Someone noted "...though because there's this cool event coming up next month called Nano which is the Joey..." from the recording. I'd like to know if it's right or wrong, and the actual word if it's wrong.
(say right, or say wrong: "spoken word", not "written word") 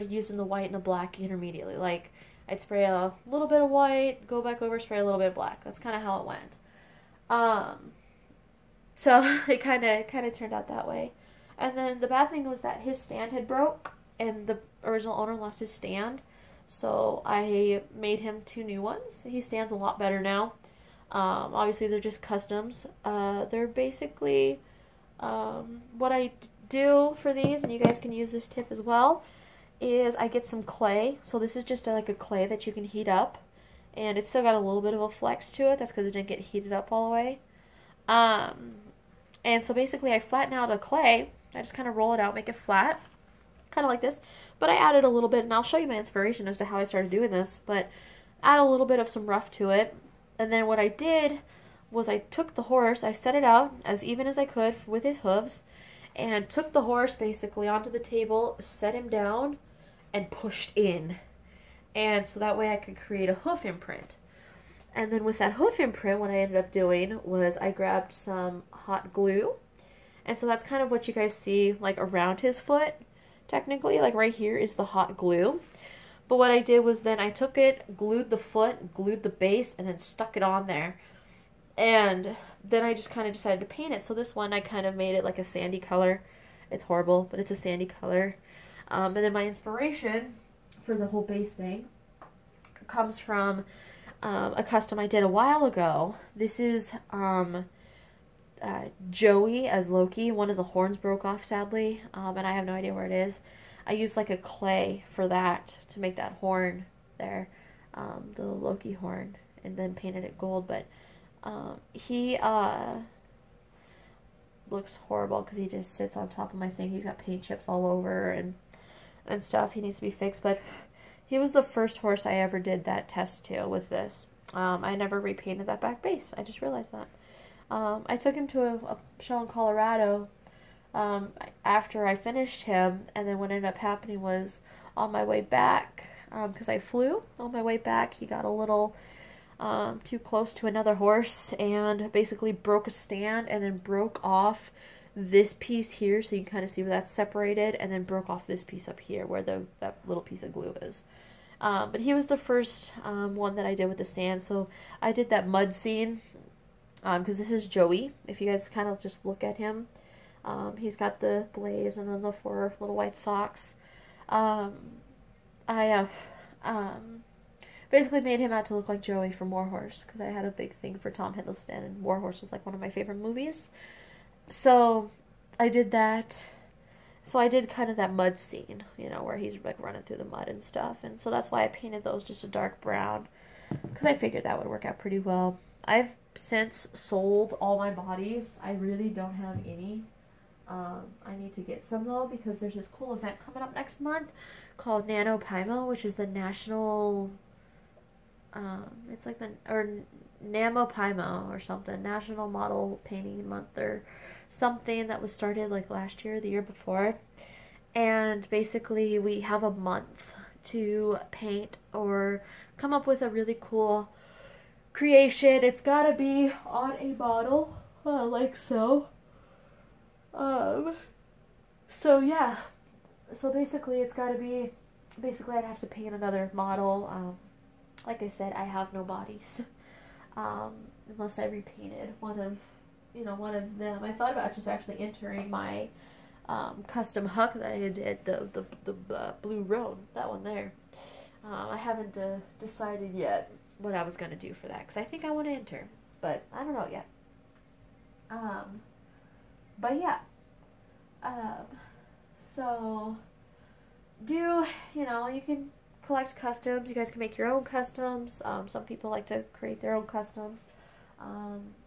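wrong: "National", not "Joey".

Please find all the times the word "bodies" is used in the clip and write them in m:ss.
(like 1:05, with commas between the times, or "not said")
3:07, 3:49.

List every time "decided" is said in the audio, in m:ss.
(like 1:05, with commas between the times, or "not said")
1:23, 4:02.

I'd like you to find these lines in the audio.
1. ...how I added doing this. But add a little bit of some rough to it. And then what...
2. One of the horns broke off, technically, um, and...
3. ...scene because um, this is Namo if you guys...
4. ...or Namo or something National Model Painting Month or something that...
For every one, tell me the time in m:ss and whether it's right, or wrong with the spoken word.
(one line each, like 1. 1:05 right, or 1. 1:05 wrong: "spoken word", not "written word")
1. 0:46 wrong: "started", not "added"
2. 1:40 wrong: "sadly", not "technically"
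3. 2:35 wrong: "Joey", not "Namo"
4. 3:19 right.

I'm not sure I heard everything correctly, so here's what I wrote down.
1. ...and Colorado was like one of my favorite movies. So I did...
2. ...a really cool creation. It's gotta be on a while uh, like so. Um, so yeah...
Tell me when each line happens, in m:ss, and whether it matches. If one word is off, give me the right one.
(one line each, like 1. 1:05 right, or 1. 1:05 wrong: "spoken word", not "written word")
1. 2:51 wrong: "Warhorse", not "Colorado"
2. 3:33 wrong: "bottle", not "while".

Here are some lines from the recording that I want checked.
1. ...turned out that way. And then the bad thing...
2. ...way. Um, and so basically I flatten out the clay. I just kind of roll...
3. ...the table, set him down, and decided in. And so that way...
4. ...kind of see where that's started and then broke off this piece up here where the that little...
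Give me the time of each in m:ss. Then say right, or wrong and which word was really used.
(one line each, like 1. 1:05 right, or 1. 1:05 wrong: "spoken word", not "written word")
1. 0:10 right
2. 0:37 right
3. 0:57 wrong: "pushed", not "decided"
4. 2:26 wrong: "separated", not "started".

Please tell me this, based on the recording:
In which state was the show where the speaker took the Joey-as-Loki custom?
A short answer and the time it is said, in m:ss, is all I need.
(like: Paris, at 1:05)
Colorado, at 2:09.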